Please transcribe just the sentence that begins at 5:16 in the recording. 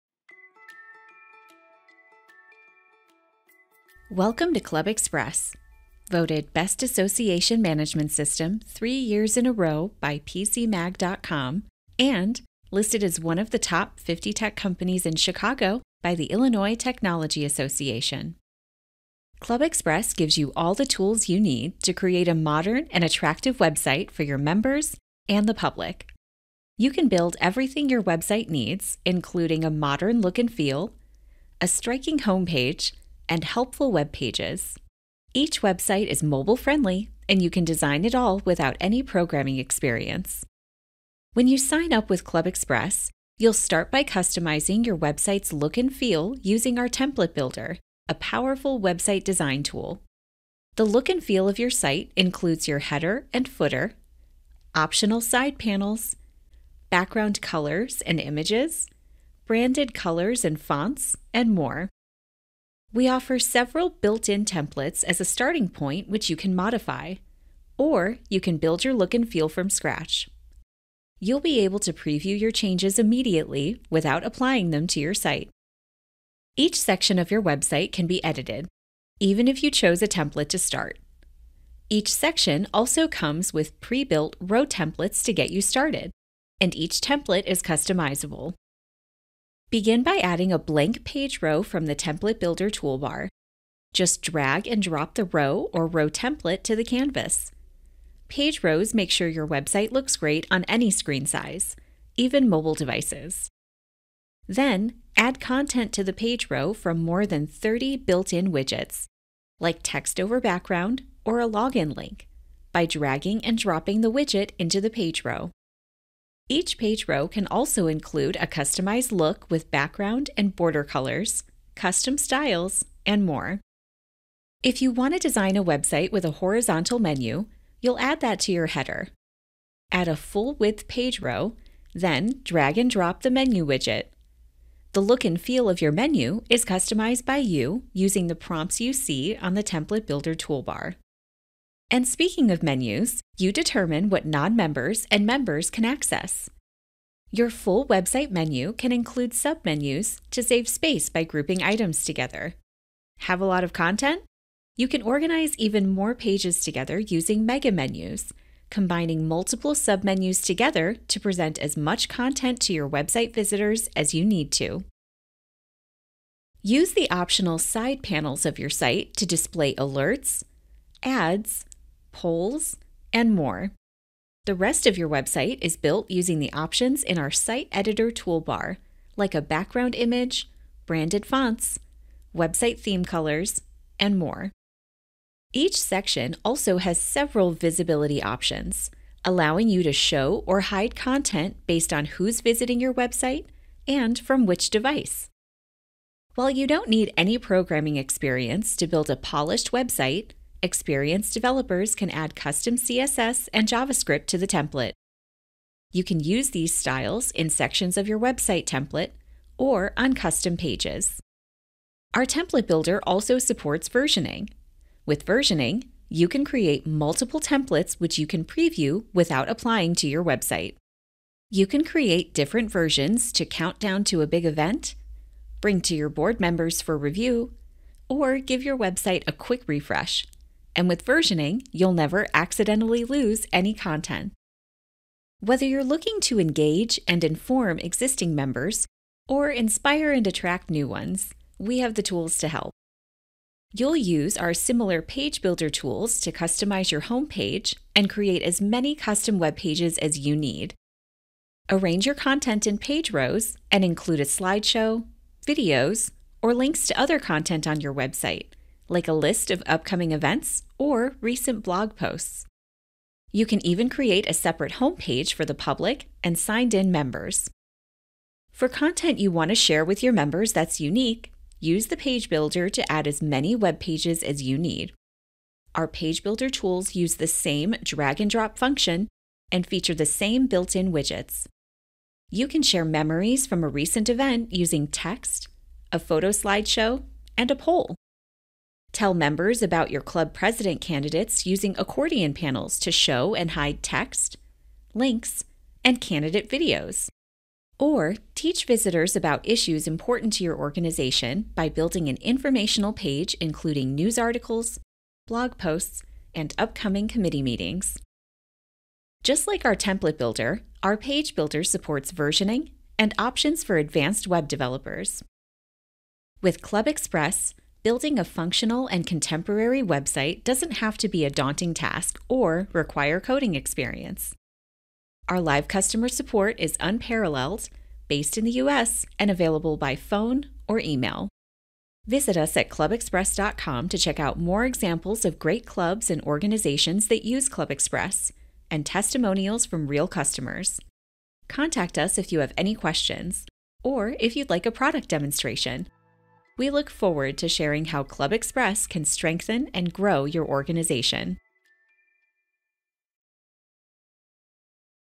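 With ClubExpress, Building a functional and contemporary website doesn't have to be a daunting task or require coding experience.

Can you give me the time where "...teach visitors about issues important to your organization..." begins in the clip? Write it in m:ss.
4:58.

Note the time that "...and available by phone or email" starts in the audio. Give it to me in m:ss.
5:29.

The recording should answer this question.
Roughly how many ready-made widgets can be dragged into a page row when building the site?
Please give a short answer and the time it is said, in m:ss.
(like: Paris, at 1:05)
30, at 1:47.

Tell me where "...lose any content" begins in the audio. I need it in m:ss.
3:53.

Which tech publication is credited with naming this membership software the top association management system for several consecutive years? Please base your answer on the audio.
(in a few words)
PCMag.com.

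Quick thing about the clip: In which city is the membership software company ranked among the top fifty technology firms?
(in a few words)
Chicago.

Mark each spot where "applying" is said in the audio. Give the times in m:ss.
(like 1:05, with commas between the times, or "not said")
1:14, 3:39.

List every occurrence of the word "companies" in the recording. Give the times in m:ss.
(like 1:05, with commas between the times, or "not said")
0:14.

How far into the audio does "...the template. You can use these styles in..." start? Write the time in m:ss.
3:24.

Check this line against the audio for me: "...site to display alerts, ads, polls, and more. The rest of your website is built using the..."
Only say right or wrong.
right.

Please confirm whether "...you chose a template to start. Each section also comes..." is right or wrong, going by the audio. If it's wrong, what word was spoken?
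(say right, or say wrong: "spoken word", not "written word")
right.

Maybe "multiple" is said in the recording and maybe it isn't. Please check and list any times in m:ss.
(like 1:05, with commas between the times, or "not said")
2:39, 3:36.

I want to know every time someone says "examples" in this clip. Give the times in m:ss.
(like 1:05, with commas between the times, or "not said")
5:34.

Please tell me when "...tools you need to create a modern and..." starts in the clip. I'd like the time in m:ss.
0:20.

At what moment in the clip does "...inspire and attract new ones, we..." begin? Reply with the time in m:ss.
3:59.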